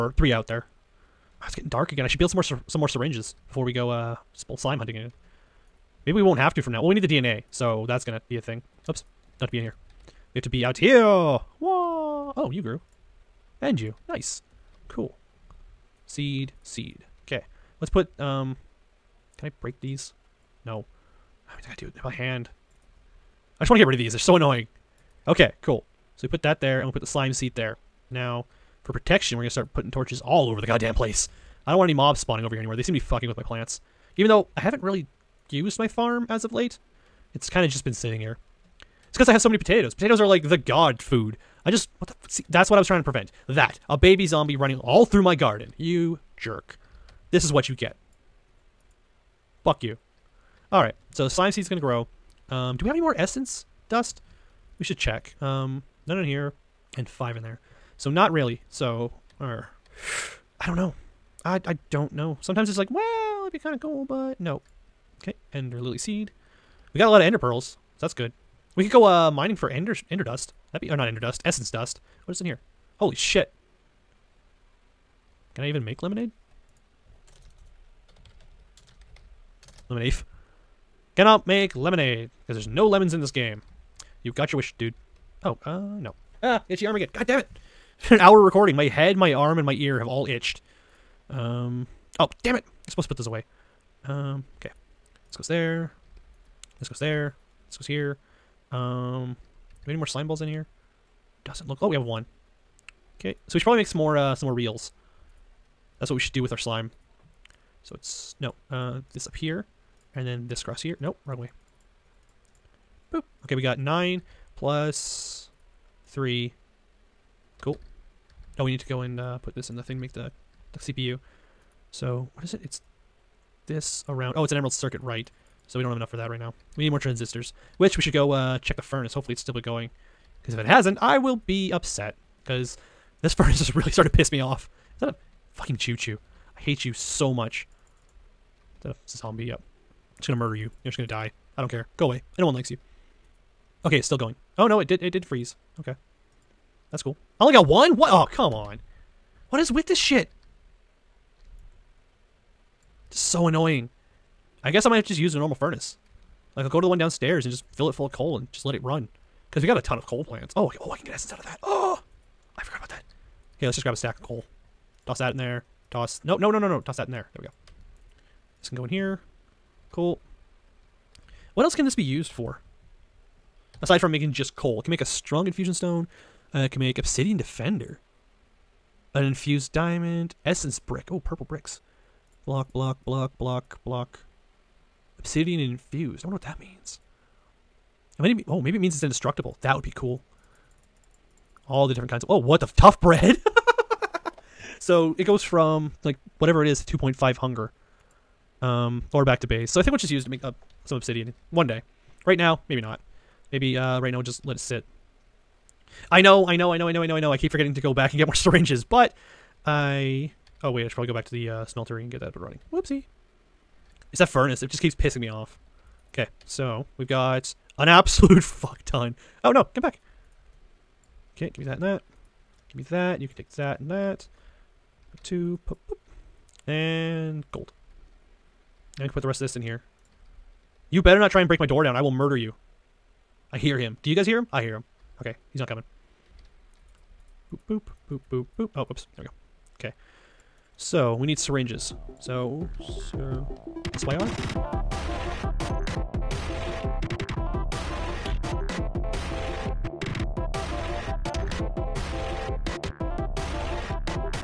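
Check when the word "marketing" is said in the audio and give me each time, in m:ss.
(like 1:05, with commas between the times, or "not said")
not said.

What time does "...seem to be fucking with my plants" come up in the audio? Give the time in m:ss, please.
0:32.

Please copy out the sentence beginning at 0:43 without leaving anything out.
That a baby zombie running all through my garden.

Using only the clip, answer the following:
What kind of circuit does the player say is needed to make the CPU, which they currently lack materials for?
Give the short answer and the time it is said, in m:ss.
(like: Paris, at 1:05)
Emerald circuit, at 2:04.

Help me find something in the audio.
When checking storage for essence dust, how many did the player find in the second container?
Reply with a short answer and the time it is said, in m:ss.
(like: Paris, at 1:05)
5, at 0:57.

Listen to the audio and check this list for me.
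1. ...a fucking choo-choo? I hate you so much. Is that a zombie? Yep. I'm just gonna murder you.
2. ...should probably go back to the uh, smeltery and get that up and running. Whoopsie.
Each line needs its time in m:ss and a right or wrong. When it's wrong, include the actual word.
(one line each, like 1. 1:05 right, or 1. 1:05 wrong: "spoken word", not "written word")
1. 2:15 right
2. 3:30 right.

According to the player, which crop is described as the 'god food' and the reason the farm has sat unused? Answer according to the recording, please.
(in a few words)
Potatoes.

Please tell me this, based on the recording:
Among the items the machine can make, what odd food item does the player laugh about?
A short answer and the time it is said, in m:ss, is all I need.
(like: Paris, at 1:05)
Tough bread, at 3:12.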